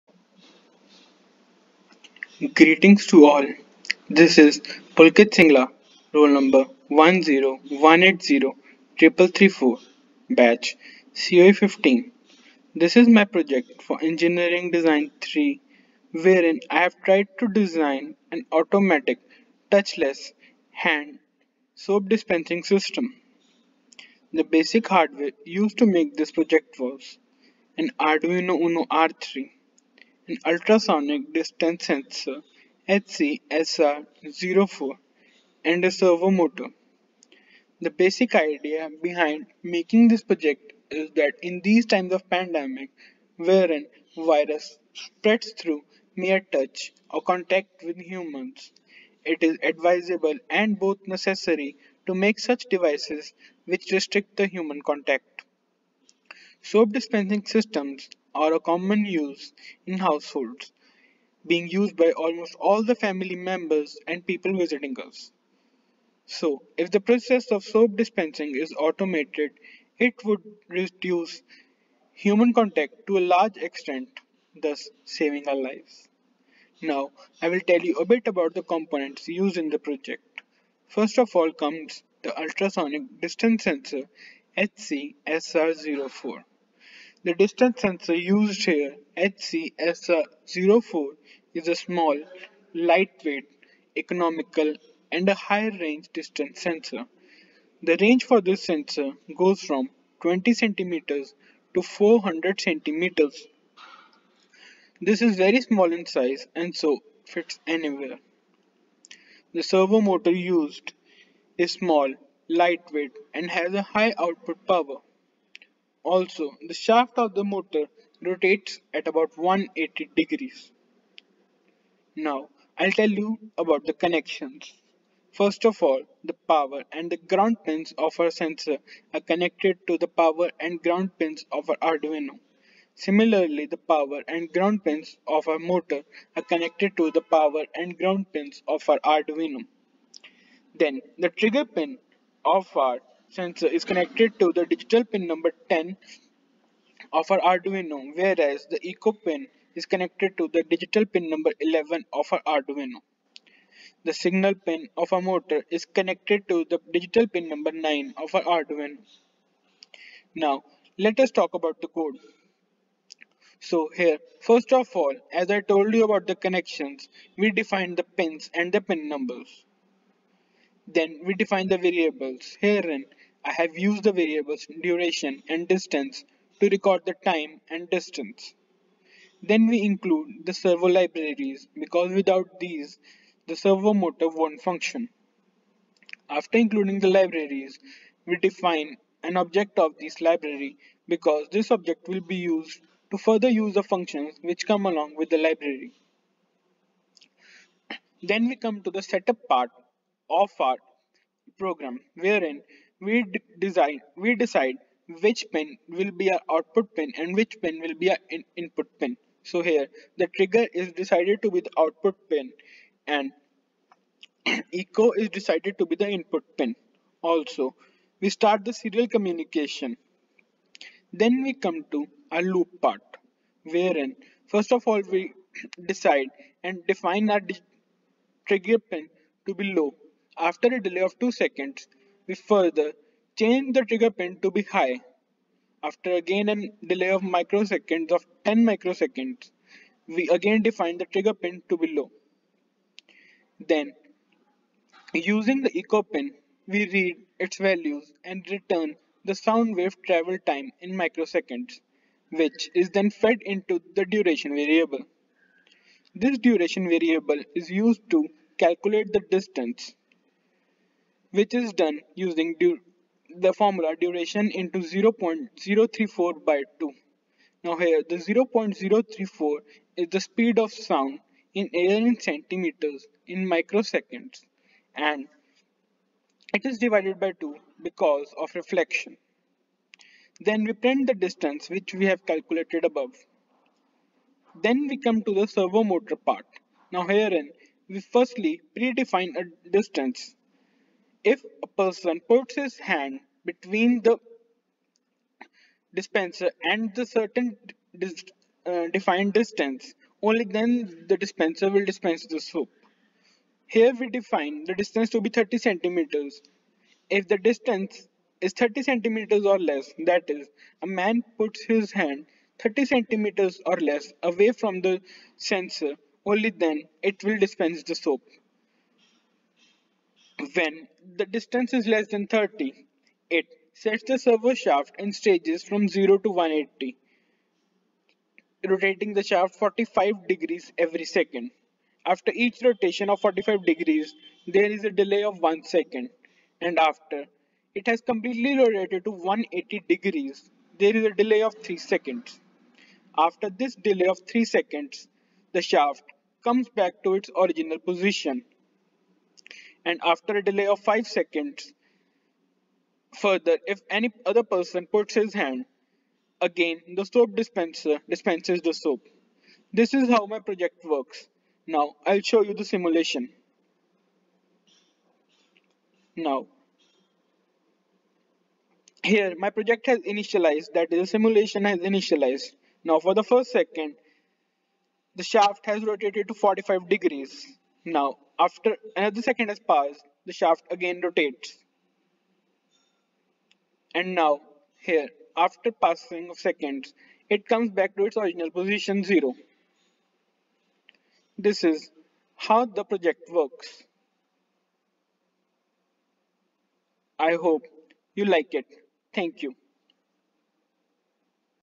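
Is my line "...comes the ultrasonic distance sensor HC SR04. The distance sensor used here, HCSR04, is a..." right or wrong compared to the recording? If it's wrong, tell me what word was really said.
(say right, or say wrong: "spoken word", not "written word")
right.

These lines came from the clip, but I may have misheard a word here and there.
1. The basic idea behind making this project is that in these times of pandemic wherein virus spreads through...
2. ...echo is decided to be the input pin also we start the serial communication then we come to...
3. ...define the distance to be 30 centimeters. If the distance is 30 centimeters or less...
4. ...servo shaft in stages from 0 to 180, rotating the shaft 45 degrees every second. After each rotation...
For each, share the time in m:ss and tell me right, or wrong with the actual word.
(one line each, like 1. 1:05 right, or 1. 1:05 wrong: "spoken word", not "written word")
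1. 0:37 right
2. 3:34 right
3. 5:04 right
4. 5:24 right.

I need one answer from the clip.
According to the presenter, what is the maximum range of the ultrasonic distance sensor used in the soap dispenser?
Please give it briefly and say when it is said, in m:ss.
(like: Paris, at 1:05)
400 centimeters, at 1:41.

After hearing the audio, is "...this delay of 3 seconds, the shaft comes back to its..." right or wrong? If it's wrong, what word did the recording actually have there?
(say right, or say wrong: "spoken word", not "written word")
right.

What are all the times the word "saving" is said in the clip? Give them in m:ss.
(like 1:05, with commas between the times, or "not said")
1:15.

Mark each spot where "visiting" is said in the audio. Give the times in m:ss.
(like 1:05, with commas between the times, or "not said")
1:04.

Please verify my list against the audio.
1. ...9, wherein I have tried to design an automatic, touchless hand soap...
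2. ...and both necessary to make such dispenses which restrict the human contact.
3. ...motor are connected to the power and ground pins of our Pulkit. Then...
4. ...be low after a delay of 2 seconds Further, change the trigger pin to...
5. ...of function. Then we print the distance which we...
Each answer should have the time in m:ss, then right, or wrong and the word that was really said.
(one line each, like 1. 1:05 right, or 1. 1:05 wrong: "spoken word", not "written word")
1. 0:15 wrong: "3", not "9"
2. 0:50 wrong: "devices", not "dispenses"
3. 2:15 wrong: "Arduino", not "Pulkit"
4. 3:49 right
5. 4:38 wrong: "reflection", not "function".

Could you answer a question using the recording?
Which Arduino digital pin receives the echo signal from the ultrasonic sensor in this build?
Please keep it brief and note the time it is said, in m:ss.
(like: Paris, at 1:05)
11, at 2:30.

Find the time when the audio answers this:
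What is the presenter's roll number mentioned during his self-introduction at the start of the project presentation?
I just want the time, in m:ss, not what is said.
0:06.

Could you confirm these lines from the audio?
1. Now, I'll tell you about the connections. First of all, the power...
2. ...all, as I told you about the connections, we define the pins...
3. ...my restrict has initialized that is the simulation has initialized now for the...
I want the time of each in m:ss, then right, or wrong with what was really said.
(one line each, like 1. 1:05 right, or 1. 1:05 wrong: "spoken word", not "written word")
1. 2:02 right
2. 2:44 right
3. 6:09 wrong: "project", not "restrict".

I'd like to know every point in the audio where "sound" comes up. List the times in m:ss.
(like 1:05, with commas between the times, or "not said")
4:09, 4:30.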